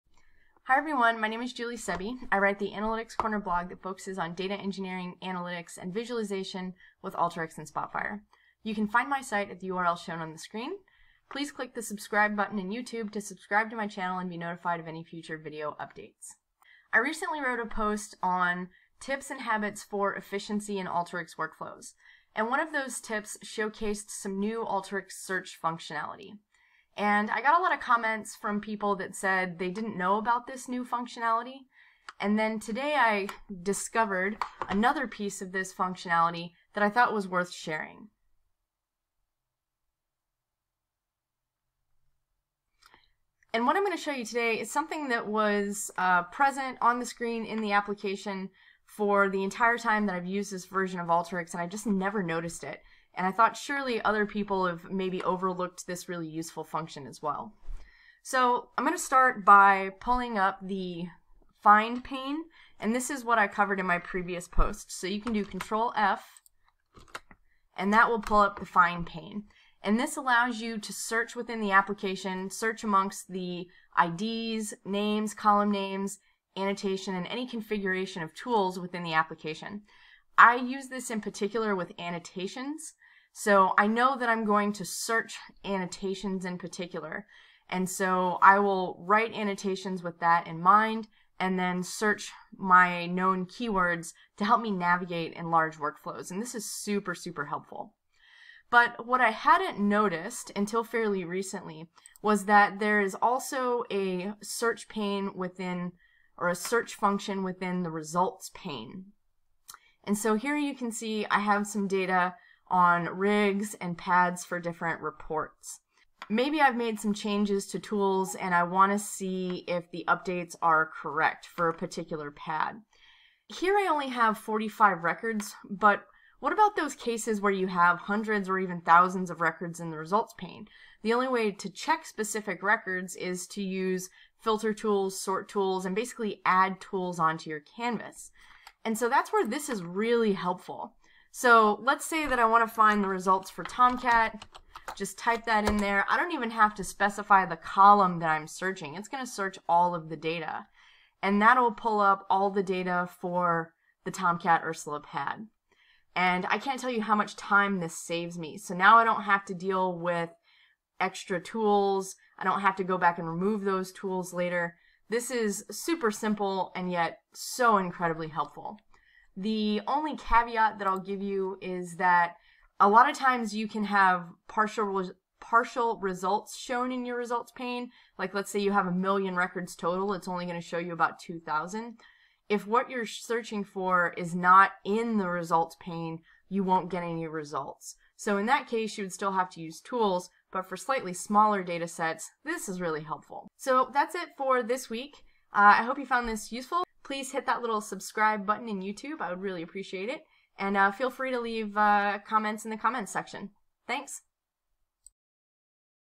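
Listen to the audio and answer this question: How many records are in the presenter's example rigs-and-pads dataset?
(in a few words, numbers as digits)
45.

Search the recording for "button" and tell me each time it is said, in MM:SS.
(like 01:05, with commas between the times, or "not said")
00:12, 03:18.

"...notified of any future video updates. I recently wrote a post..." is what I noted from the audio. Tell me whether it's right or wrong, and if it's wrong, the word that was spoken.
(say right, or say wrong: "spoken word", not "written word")
right.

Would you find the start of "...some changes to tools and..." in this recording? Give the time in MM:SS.
01:56.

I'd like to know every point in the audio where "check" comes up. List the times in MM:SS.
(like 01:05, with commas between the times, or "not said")
02:11.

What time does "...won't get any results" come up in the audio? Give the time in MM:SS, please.
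03:06.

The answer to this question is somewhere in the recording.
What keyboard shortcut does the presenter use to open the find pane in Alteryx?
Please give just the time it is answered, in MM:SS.
01:05.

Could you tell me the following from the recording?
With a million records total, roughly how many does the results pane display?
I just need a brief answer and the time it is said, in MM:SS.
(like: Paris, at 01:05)
2,000, at 03:01.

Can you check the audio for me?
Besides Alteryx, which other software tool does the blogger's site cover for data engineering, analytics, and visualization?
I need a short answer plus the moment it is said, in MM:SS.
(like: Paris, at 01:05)
Spotfire, at 00:07.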